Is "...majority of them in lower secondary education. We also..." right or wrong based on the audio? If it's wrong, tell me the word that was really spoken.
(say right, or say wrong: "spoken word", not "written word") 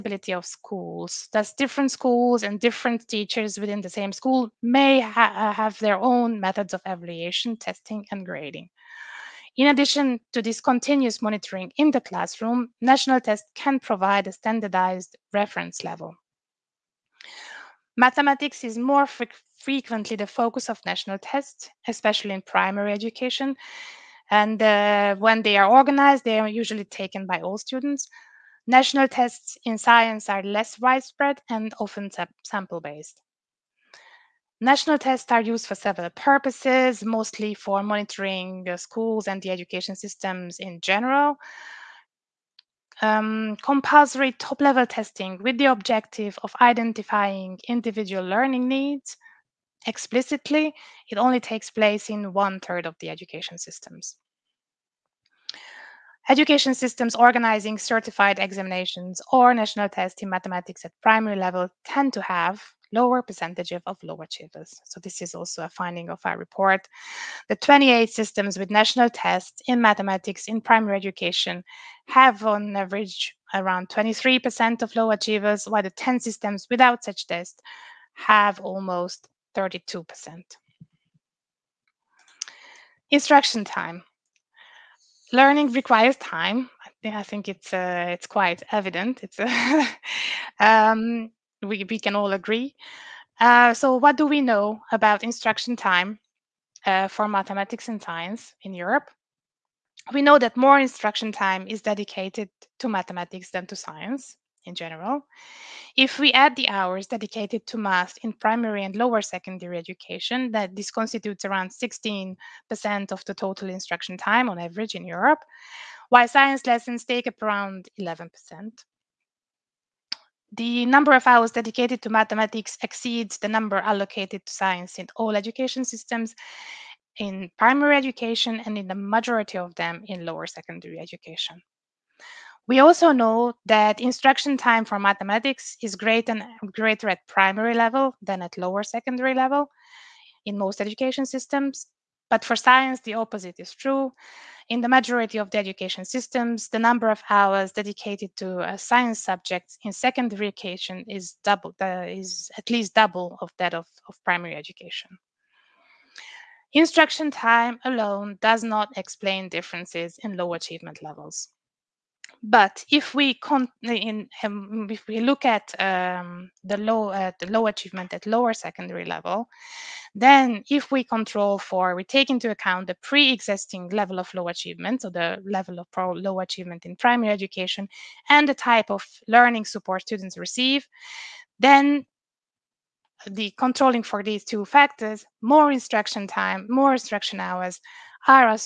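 right.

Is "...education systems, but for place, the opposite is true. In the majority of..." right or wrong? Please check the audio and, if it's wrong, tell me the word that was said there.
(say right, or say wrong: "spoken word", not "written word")
wrong: "science", not "place".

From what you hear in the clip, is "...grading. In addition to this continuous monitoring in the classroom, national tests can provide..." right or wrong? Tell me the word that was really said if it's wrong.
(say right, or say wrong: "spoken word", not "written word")
right.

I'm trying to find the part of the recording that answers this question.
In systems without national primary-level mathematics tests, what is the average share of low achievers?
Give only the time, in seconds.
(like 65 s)
78 s.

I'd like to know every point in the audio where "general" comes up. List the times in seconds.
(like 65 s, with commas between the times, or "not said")
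40 s, 104 s.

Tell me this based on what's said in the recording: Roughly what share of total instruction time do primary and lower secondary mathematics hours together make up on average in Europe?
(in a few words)
16%.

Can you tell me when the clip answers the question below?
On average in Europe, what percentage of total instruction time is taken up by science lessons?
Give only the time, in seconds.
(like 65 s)
118 s.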